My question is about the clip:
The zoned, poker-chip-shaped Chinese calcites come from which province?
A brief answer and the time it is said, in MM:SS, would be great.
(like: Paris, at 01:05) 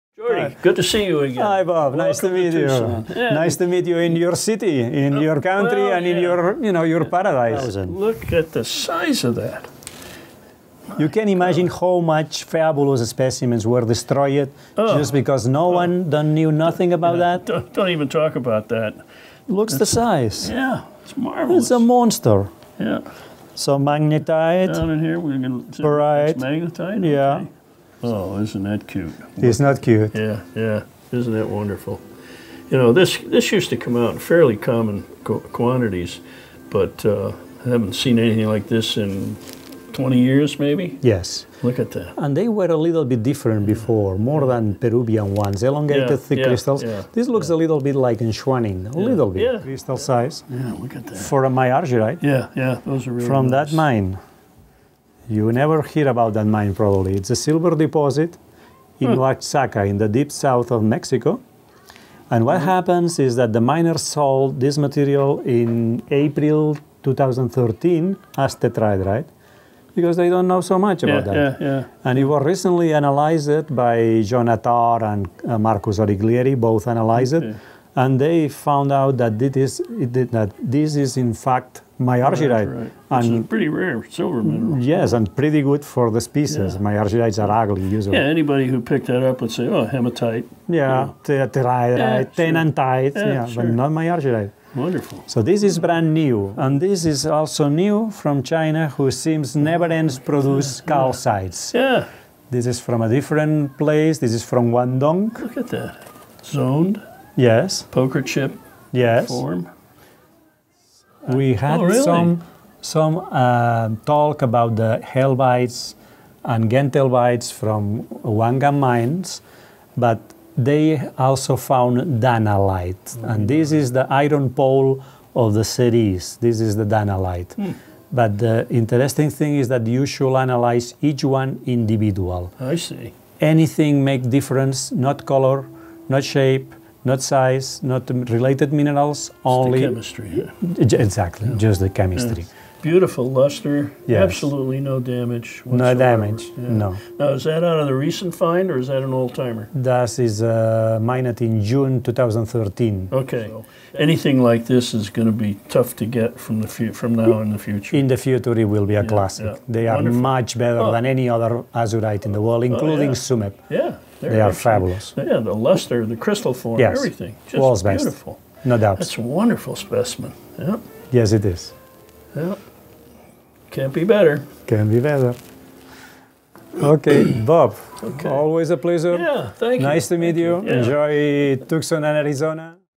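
Guangdong, at 01:44.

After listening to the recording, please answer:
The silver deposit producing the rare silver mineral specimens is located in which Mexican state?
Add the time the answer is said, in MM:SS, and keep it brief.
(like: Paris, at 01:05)
Oaxaca, at 00:59.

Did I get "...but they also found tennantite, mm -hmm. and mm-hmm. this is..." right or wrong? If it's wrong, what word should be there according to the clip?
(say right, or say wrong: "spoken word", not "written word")
wrong: "danalite", not "tennantite".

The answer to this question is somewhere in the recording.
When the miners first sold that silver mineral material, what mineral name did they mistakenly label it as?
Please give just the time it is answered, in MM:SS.
01:08.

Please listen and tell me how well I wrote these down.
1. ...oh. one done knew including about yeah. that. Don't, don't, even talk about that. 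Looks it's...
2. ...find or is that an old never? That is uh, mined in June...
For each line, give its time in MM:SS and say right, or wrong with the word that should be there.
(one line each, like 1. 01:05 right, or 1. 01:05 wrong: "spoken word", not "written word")
1. 00:15 wrong: "nothing", not "including"
2. 02:28 wrong: "timer", not "never".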